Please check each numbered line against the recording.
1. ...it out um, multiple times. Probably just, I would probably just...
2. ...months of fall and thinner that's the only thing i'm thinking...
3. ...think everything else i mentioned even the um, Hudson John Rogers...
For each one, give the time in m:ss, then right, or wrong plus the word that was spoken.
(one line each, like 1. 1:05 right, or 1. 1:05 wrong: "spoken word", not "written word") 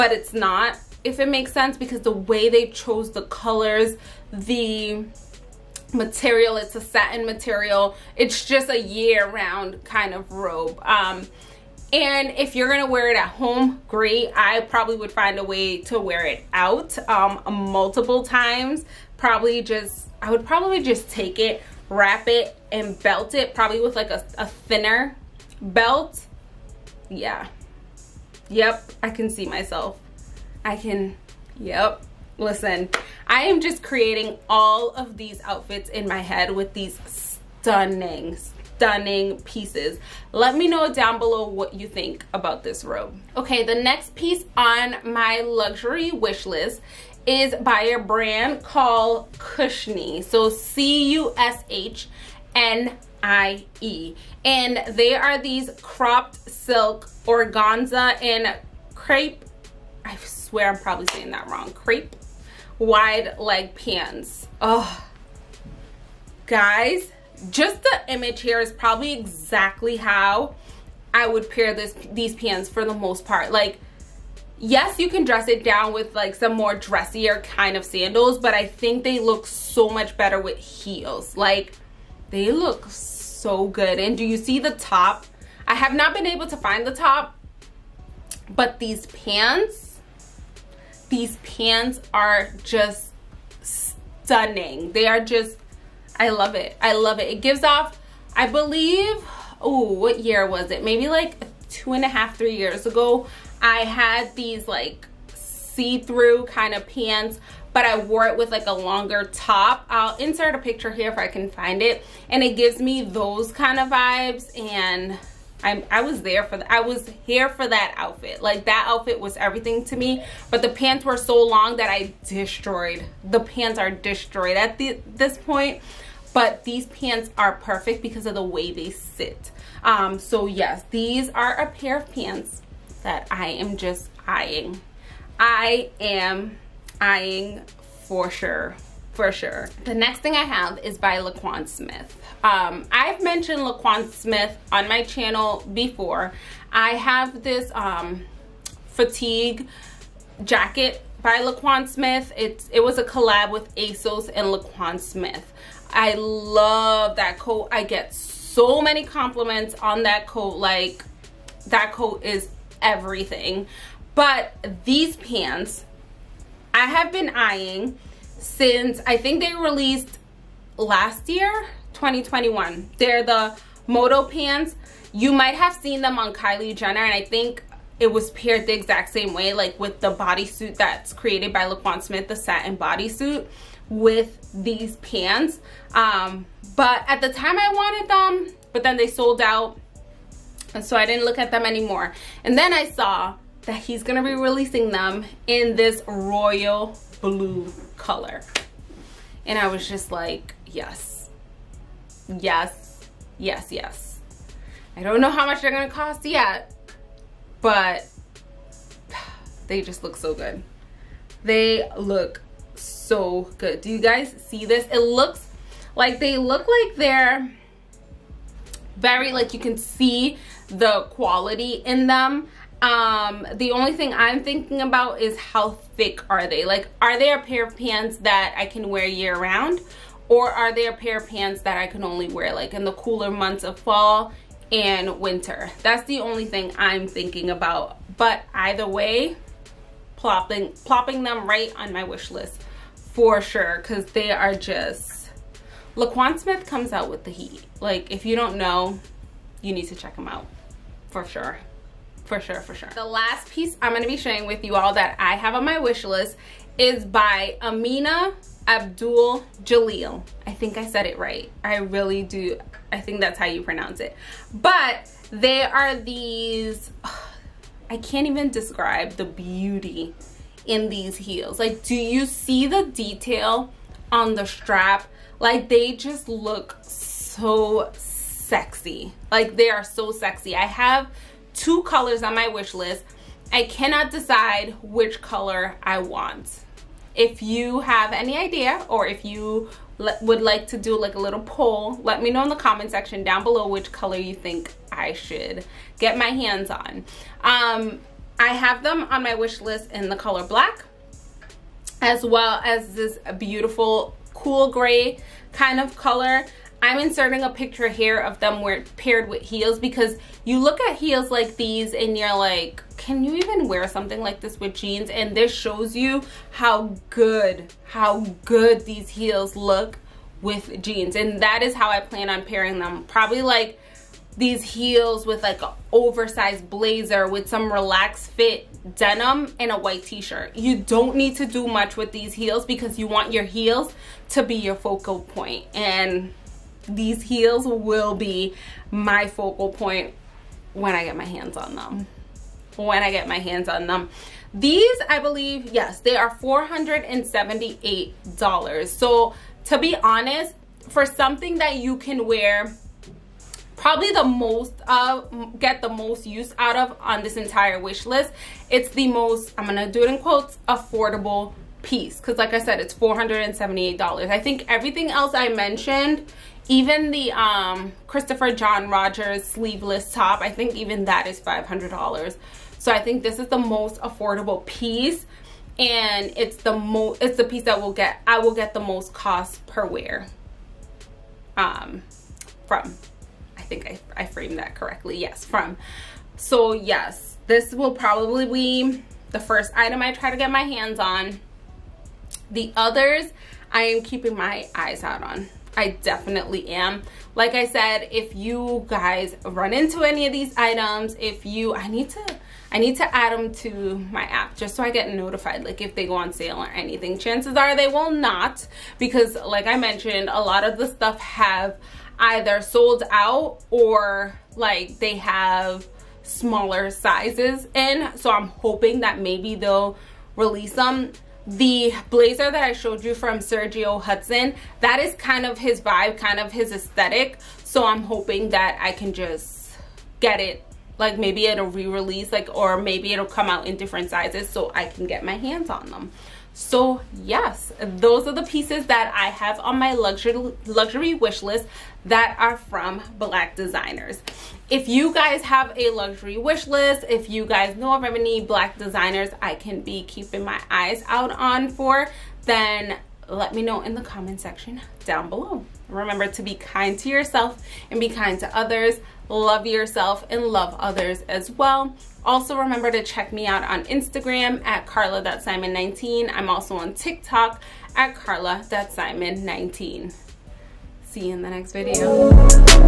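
1. 0:16 right
2. 3:53 wrong: "winter", not "thinner"
3. 6:04 wrong: "Christopher", not "Hudson".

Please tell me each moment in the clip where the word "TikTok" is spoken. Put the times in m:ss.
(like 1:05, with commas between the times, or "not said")
7:46.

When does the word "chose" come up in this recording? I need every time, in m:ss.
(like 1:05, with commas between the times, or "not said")
0:02.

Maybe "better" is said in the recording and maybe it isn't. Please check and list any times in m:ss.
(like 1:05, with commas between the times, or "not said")
1:20.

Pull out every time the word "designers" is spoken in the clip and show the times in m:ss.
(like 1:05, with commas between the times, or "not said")
7:23, 7:28.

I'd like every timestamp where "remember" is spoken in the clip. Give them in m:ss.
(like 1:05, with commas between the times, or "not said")
7:35, 7:42.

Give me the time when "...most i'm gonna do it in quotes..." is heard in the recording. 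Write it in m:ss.
5:59.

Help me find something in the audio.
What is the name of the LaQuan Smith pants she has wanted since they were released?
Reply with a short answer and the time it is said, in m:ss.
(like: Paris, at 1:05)
Moto pants, at 2:53.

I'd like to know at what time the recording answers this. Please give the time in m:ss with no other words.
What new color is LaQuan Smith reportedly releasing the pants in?
3:16.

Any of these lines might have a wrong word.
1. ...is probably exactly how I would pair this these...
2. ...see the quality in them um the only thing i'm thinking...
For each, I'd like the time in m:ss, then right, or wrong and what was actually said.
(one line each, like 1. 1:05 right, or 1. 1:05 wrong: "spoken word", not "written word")
1. 1:08 right
2. 3:39 right.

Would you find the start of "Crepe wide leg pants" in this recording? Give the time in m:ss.
1:01.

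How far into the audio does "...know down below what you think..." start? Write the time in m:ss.
0:40.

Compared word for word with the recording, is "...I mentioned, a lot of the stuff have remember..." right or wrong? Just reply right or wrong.
wrong.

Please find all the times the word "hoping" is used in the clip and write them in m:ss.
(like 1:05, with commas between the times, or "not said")
6:58, 7:08.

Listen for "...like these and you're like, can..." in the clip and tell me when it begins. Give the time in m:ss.
5:11.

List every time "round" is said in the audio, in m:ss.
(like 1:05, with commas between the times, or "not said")
0:08, 3:49.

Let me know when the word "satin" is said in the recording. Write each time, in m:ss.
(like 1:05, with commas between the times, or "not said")
0:06, 3:02.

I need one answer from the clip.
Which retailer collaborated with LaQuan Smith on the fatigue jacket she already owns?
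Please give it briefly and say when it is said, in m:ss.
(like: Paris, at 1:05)
ASOS, at 2:33.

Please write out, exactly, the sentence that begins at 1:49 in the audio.
I'll insert a picture here if I can find it.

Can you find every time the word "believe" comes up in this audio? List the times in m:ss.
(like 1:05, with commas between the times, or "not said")
1:38, 5:45.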